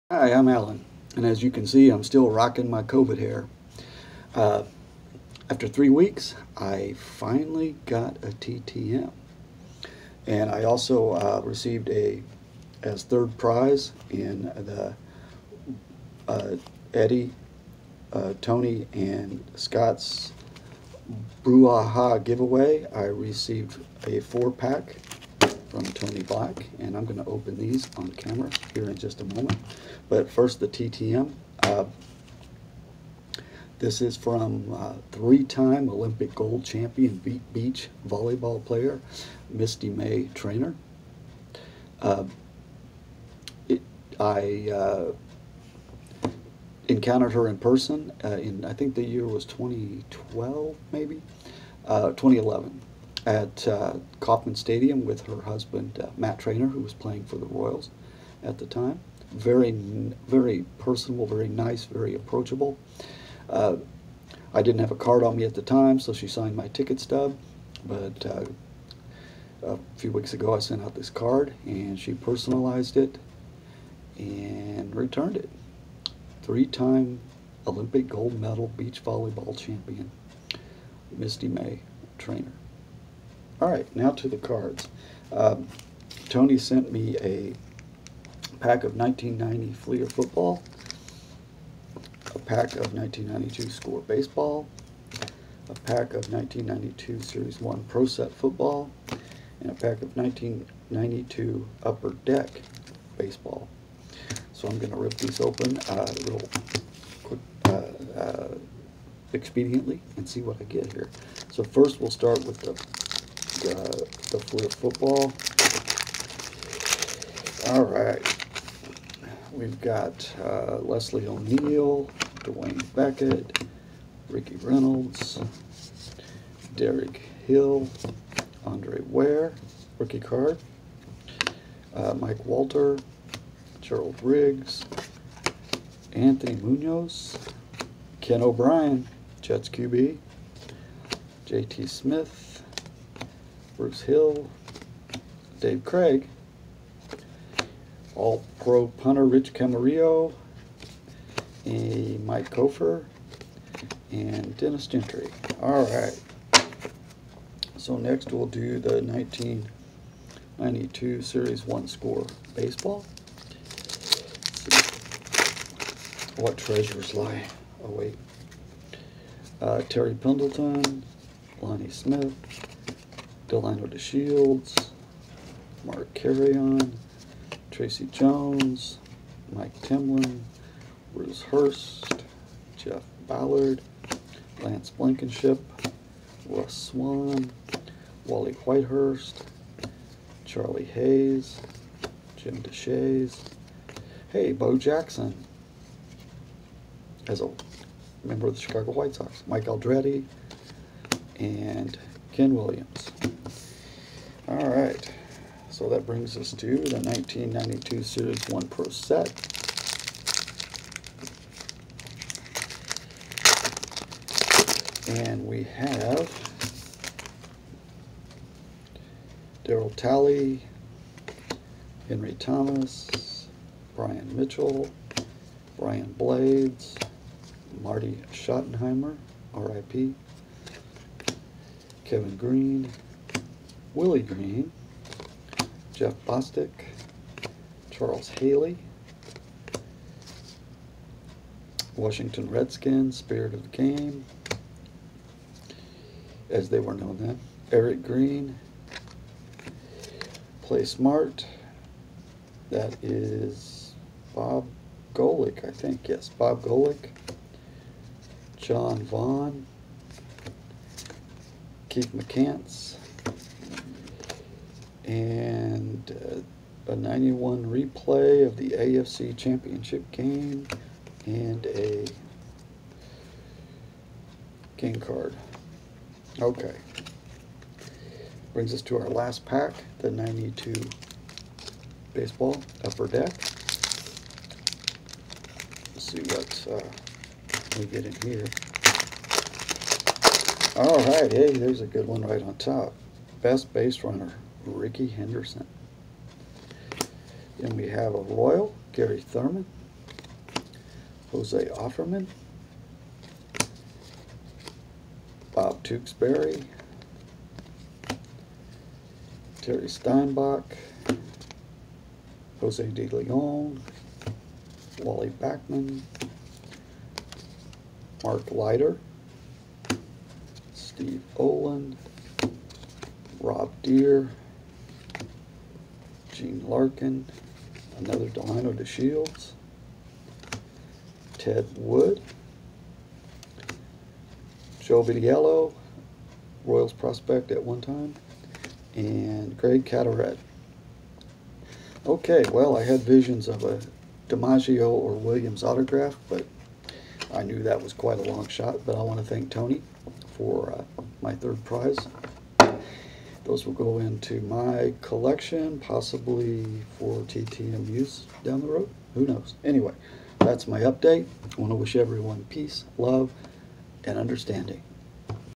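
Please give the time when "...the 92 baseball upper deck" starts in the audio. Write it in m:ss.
4:39.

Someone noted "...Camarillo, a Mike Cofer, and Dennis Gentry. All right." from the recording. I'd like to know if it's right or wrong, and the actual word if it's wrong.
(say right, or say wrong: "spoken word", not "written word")
right.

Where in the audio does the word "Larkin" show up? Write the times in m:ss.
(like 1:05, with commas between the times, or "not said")
5:26.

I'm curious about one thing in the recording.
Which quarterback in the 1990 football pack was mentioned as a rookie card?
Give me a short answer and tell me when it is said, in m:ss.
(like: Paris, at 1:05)
Andre Ware, at 2:08.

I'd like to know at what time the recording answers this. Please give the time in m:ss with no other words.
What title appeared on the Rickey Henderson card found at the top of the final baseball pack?
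4:53.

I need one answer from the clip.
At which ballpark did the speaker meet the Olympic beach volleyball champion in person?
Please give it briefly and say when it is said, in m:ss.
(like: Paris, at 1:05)
Kauffman Stadium, at 0:54.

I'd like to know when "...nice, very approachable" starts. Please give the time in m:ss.
1:01.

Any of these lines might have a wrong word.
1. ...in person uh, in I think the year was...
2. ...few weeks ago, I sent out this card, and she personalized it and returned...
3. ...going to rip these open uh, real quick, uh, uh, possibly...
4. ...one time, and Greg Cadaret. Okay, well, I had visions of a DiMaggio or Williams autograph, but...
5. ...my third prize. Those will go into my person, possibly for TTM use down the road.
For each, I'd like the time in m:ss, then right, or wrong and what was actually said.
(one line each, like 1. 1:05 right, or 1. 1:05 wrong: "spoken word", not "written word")
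1. 0:47 right
2. 1:09 right
3. 1:44 wrong: "expediently", not "possibly"
4. 5:37 right
5. 5:51 wrong: "collection", not "person".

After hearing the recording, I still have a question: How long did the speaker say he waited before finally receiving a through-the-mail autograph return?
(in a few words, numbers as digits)
3 weeks.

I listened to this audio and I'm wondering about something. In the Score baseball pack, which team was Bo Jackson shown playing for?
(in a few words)
Chicago White Sox.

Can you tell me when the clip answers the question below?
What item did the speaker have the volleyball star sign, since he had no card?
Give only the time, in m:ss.
1:06.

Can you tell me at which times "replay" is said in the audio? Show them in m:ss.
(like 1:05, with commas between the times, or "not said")
4:27.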